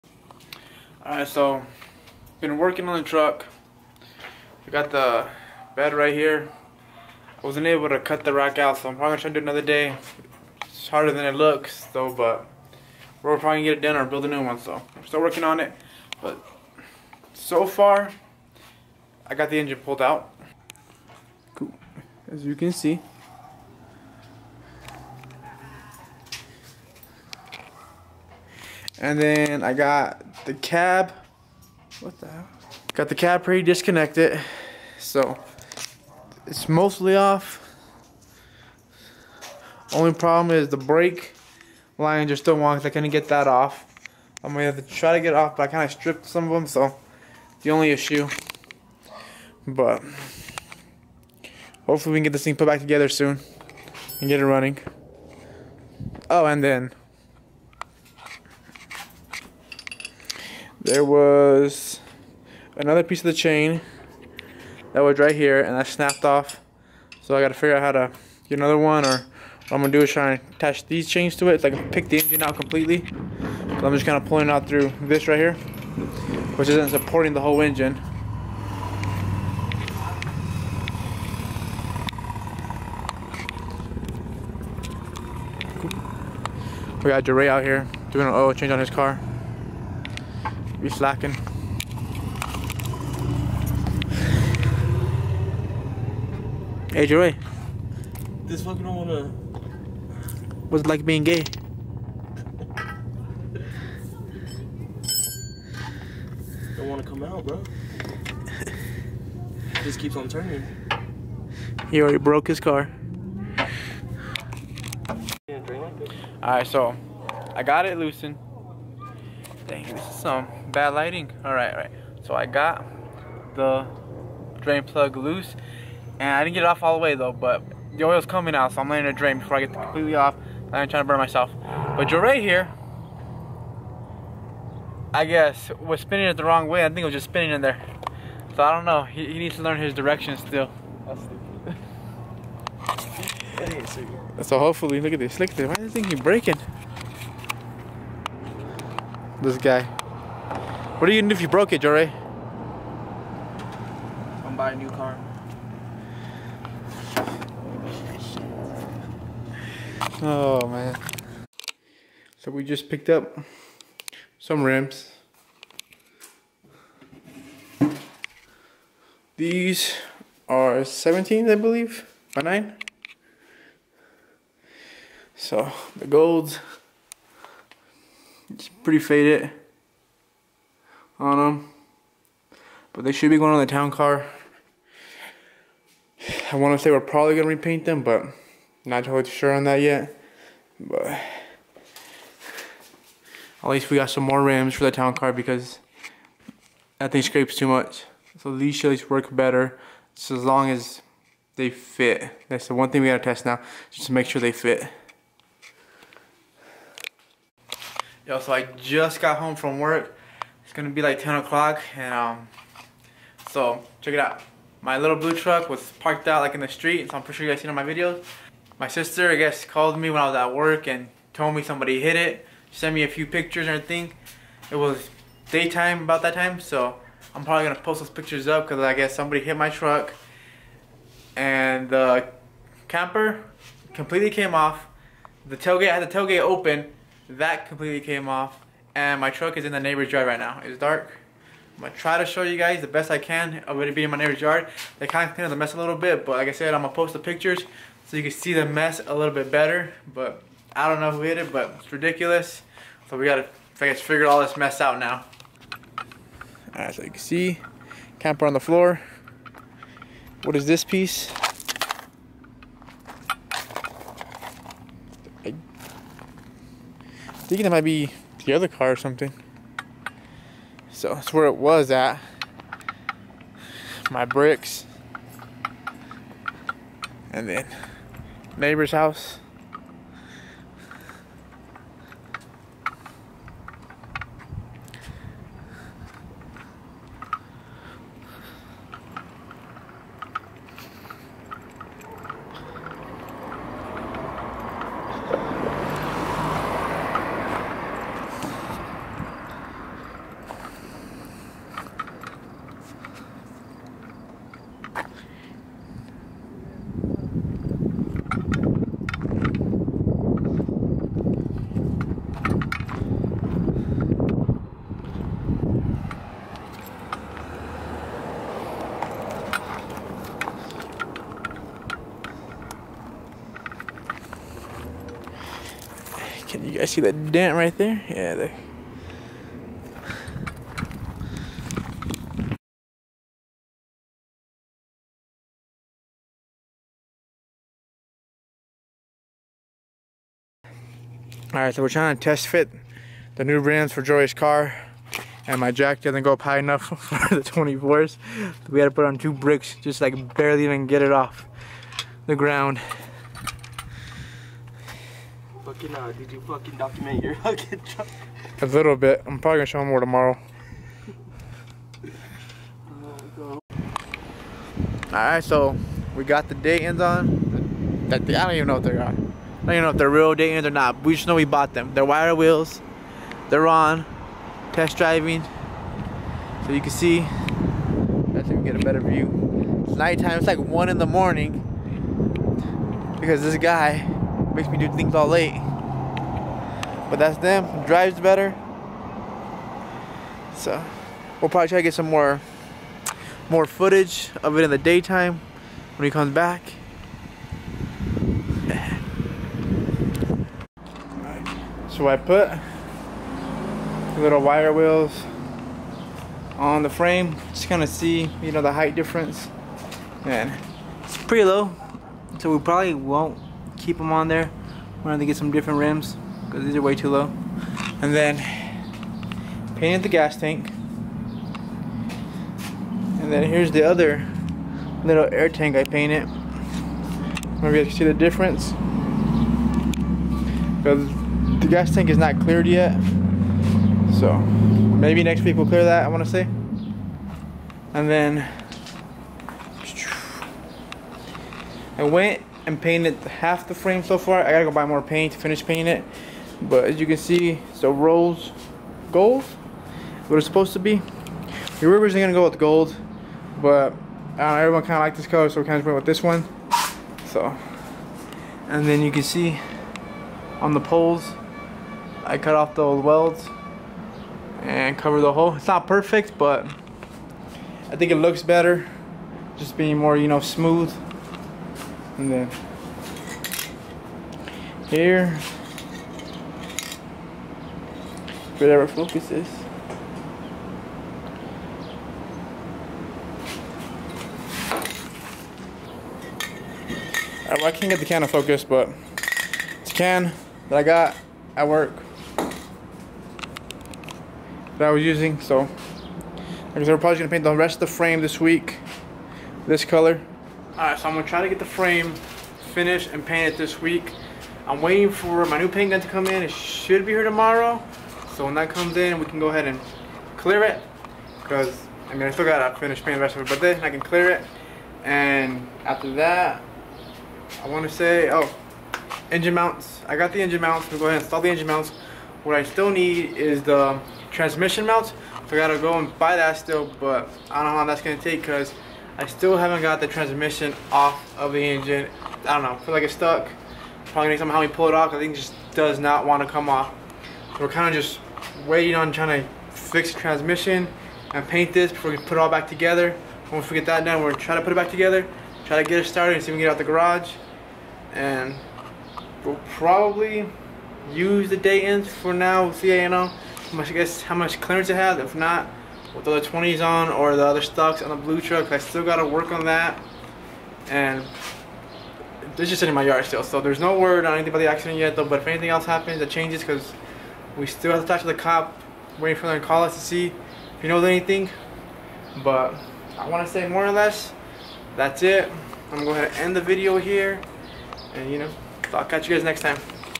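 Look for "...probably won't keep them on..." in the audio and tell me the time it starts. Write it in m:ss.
6:52.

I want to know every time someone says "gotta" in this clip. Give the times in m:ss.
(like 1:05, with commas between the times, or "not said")
1:07, 4:13, 7:24, 8:32, 8:45.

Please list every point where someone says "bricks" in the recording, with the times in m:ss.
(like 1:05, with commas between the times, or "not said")
4:34, 5:49.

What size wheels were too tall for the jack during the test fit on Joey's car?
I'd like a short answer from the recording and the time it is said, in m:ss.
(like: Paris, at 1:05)
24s, at 5:47.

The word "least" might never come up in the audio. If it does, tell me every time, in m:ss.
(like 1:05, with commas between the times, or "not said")
3:13, 3:18.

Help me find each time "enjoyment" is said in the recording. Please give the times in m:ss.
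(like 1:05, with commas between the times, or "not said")
not said.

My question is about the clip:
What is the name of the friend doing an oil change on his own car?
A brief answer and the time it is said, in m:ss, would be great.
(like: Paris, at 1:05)
Duray, at 1:27.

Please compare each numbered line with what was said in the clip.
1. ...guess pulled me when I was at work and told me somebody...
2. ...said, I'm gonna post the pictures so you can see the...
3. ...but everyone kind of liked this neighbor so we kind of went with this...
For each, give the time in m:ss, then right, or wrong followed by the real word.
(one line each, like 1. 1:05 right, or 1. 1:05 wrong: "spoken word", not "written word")
1. 3:39 wrong: "called", not "pulled"
2. 4:06 right
3. 7:33 wrong: "color", not "neighbor".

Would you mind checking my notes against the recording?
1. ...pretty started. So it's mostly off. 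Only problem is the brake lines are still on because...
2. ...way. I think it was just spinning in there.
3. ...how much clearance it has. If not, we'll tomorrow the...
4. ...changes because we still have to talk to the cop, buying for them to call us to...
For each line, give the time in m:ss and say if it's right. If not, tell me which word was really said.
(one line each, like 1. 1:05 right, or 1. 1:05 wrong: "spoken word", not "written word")
1. 0:33 wrong: "disconnected", not "started"
2. 2:16 right
3. 9:14 wrong: "throw", not "tomorrow"
4. 9:26 wrong: "waiting", not "buying".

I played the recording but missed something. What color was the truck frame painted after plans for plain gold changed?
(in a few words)
Rose gold.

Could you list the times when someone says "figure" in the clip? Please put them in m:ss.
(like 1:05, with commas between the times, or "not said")
1:07, 4:14.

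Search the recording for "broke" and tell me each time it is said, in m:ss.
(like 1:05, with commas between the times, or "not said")
1:52, 2:31.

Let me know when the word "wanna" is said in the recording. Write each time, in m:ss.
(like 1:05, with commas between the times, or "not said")
1:38, 1:46.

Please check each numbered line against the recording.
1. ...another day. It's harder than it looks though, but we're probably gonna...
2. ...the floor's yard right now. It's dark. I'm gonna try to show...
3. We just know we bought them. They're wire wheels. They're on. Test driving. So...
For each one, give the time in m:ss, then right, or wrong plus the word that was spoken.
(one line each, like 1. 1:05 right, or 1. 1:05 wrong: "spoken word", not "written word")
1. 0:09 right
2. 3:59 wrong: "neighbor", not "floor"
3. 6:11 right.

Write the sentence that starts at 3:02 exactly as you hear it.
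But they should be going on the town car.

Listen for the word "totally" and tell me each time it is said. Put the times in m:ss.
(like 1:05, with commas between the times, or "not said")
3:09.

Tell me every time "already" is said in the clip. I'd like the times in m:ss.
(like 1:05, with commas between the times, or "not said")
1:52.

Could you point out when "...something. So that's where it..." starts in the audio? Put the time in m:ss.
4:28.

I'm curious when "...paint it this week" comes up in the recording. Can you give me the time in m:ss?
8:23.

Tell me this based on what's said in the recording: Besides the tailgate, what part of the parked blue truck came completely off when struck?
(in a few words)
The camper.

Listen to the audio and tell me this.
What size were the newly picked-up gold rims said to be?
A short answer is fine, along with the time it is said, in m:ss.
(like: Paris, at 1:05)
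17 by 9, at 2:50.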